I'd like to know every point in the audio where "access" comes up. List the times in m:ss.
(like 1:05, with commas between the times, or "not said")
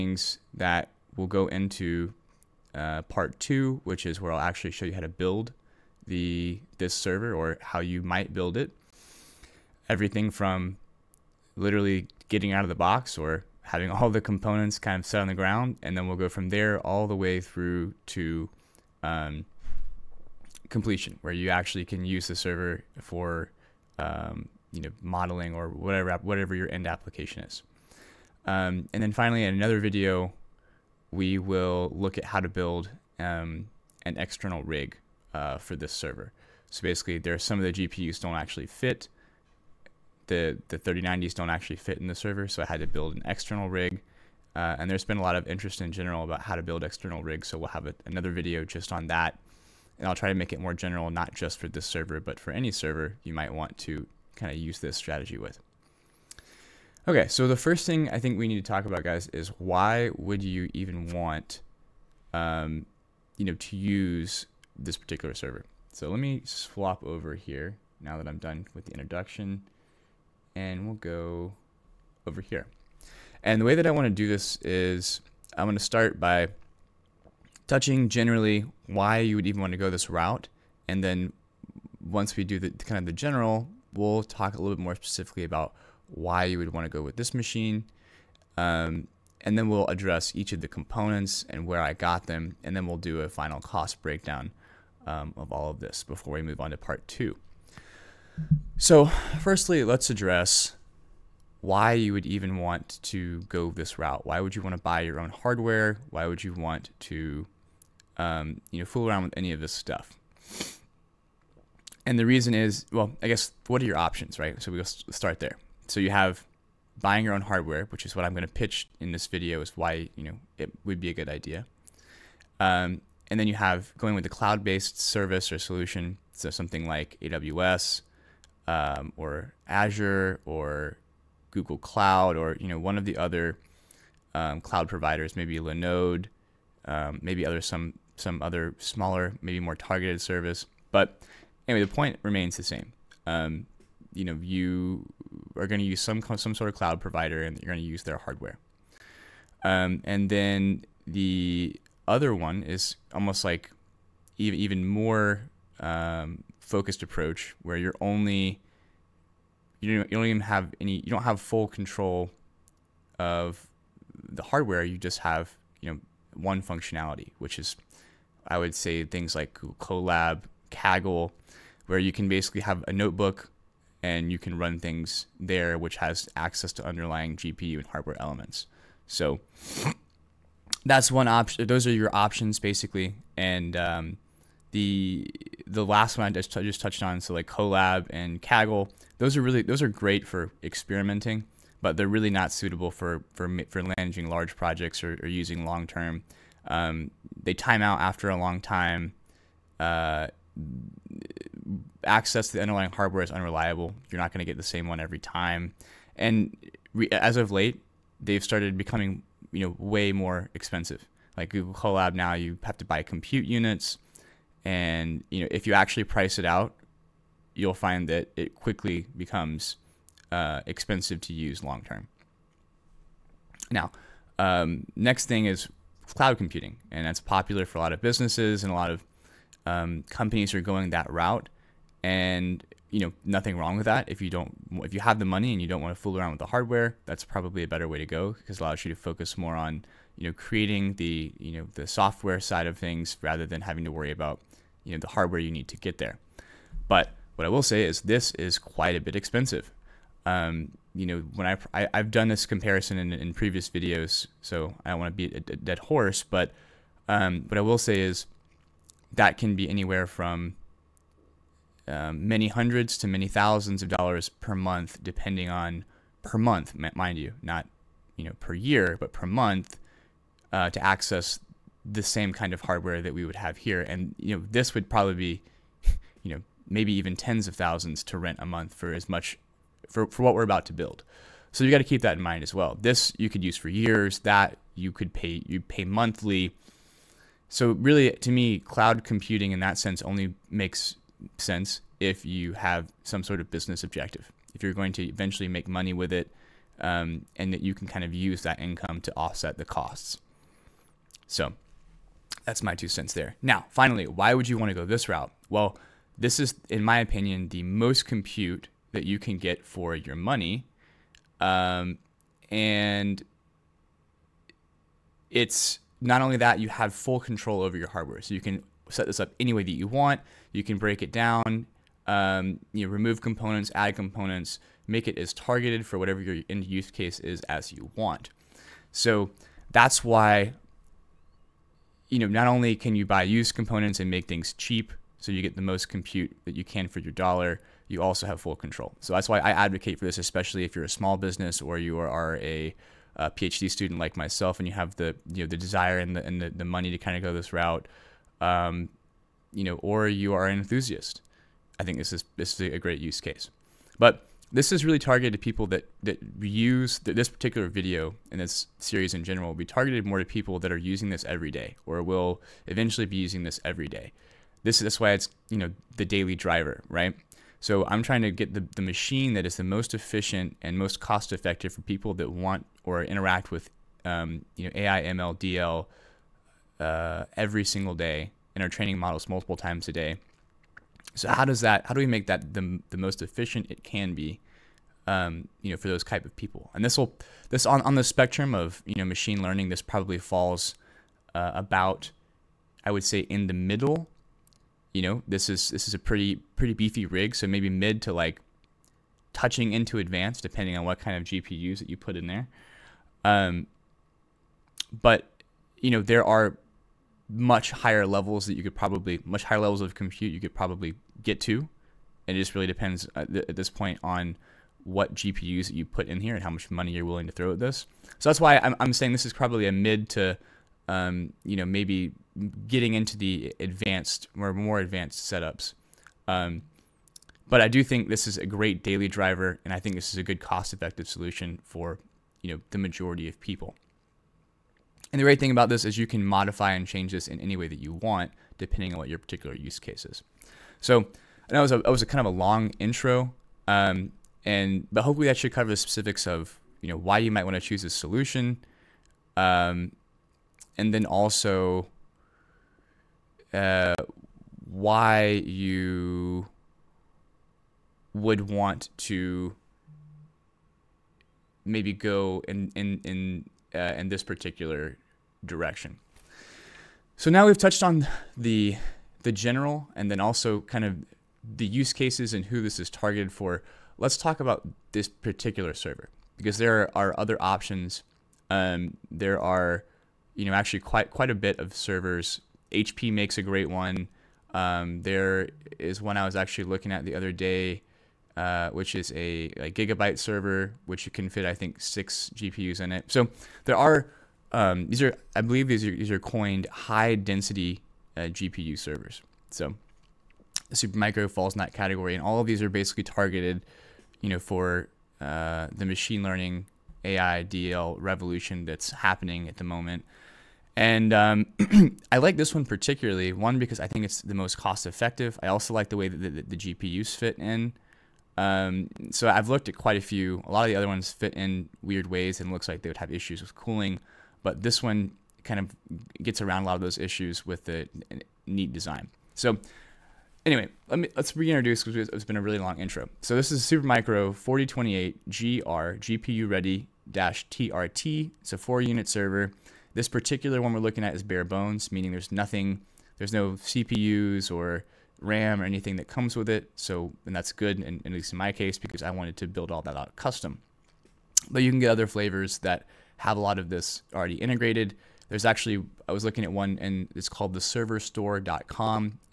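2:56, 3:22, 4:30.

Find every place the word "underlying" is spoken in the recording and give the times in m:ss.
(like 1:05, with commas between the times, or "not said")
2:56, 3:22.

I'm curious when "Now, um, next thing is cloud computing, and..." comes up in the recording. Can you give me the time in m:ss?
3:43.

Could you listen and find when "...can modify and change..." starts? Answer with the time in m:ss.
7:16.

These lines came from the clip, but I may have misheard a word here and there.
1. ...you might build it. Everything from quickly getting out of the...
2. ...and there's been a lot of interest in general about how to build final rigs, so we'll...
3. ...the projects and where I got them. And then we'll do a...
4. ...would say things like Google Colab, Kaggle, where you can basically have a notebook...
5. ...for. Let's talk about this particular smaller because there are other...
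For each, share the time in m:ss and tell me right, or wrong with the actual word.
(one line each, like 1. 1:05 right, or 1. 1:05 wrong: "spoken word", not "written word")
1. 0:07 wrong: "literally", not "quickly"
2. 0:44 wrong: "external", not "final"
3. 1:30 wrong: "components", not "projects"
4. 2:48 right
5. 7:53 wrong: "server", not "smaller".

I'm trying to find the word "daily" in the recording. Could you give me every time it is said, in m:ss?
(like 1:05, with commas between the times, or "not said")
6:06, 7:08.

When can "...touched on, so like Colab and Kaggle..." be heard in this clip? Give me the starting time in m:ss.
3:06.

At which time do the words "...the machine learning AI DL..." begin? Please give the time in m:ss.
8:25.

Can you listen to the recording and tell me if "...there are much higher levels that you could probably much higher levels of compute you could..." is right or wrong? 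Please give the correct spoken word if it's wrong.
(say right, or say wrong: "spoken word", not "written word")
right.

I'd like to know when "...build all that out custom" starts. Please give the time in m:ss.
9:09.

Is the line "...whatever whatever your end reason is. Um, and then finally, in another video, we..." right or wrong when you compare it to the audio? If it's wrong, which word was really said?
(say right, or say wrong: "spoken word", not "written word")
wrong: "application", not "reason".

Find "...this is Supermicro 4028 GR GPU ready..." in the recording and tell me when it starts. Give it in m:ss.
8:53.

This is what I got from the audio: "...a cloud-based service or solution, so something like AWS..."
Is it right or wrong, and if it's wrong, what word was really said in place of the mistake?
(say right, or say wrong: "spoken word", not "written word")
right.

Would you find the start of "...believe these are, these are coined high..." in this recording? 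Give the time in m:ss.
8:15.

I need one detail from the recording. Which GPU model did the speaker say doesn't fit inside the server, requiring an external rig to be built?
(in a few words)
3090s.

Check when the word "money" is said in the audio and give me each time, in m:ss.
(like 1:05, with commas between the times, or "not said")
3:55, 4:55, 5:10, 5:46, 6:56.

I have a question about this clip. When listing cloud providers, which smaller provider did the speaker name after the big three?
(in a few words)
Linode.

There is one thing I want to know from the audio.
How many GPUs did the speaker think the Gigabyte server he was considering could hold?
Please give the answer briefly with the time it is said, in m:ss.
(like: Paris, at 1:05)
6, at 8:11.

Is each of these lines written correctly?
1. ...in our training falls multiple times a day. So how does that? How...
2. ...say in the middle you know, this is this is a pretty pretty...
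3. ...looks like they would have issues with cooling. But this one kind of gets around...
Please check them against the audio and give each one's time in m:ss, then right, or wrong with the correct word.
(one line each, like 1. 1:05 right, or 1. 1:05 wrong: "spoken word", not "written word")
1. 6:18 wrong: "models", not "falls"
2. 6:33 right
3. 8:42 right.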